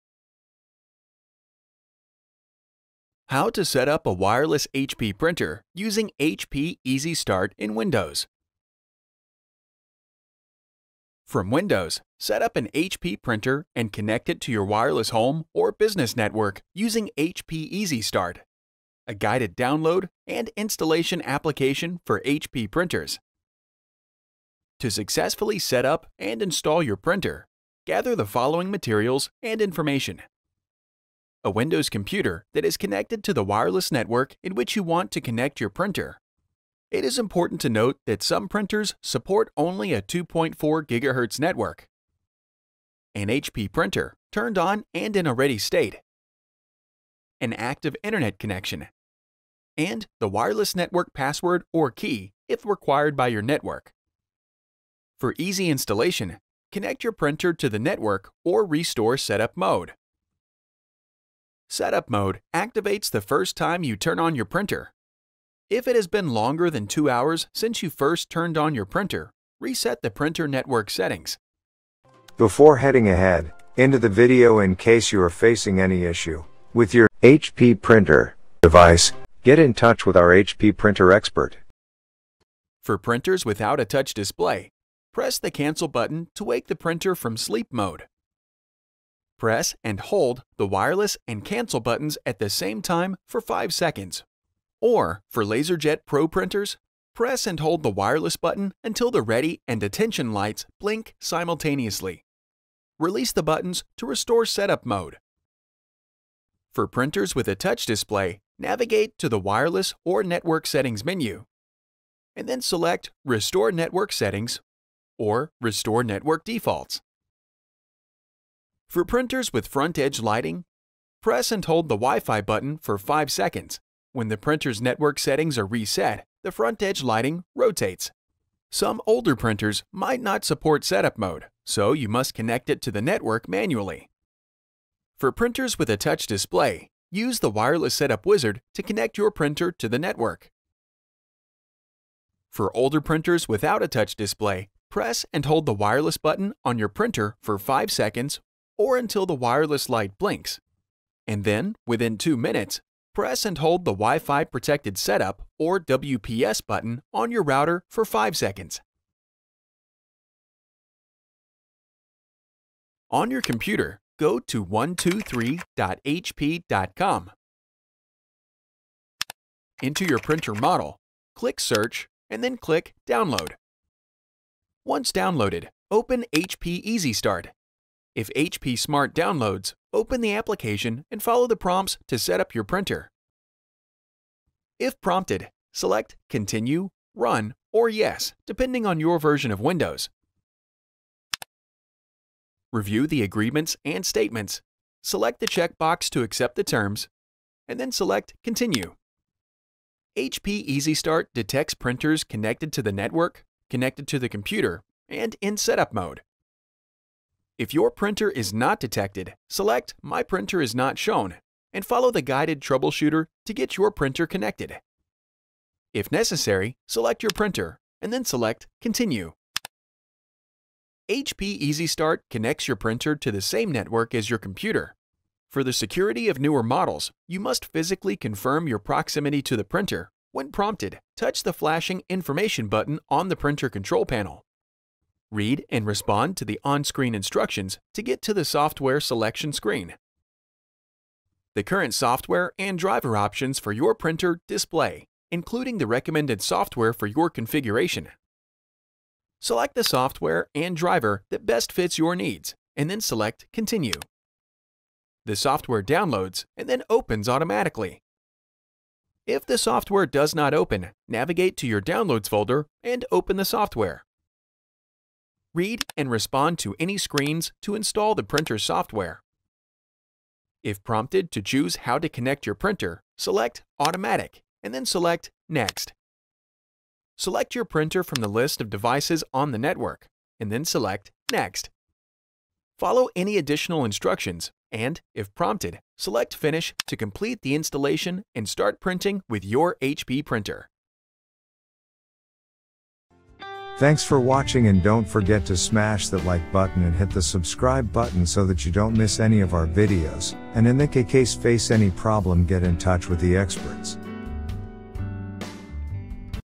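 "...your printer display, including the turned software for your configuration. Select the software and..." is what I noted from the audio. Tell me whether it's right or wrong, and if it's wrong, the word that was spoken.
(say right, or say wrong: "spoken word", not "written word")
wrong: "recommended", not "turned".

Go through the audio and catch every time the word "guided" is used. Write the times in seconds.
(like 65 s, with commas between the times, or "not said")
19 s, 212 s.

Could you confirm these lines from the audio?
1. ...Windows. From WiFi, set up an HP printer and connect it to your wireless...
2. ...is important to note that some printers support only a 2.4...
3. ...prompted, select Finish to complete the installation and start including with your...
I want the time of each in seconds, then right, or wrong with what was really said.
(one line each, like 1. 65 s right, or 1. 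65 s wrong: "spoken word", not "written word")
1. 7 s wrong: "Windows", not "WiFi"
2. 37 s right
3. 285 s wrong: "printing", not "including".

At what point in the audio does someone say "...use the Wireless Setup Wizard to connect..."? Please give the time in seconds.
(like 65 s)
137 s.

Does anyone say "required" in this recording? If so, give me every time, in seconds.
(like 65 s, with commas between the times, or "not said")
52 s.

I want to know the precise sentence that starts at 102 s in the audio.
Release the buttons to restore setup mode.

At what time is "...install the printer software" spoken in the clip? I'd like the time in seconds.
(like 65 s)
267 s.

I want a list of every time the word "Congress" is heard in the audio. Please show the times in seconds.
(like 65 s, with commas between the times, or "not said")
not said.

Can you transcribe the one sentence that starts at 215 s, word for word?
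If necessary, select your printer and then select Continue.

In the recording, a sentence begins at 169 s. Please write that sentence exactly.
Into your printer model, click Search, and then click Download.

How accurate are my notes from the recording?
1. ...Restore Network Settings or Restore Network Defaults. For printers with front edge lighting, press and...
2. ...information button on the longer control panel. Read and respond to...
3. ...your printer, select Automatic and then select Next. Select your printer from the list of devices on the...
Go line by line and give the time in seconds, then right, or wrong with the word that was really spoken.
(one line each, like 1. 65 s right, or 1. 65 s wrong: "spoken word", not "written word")
1. 113 s right
2. 232 s wrong: "printer", not "longer"
3. 272 s right.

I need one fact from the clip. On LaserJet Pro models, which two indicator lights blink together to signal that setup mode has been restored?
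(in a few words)
ready and attention.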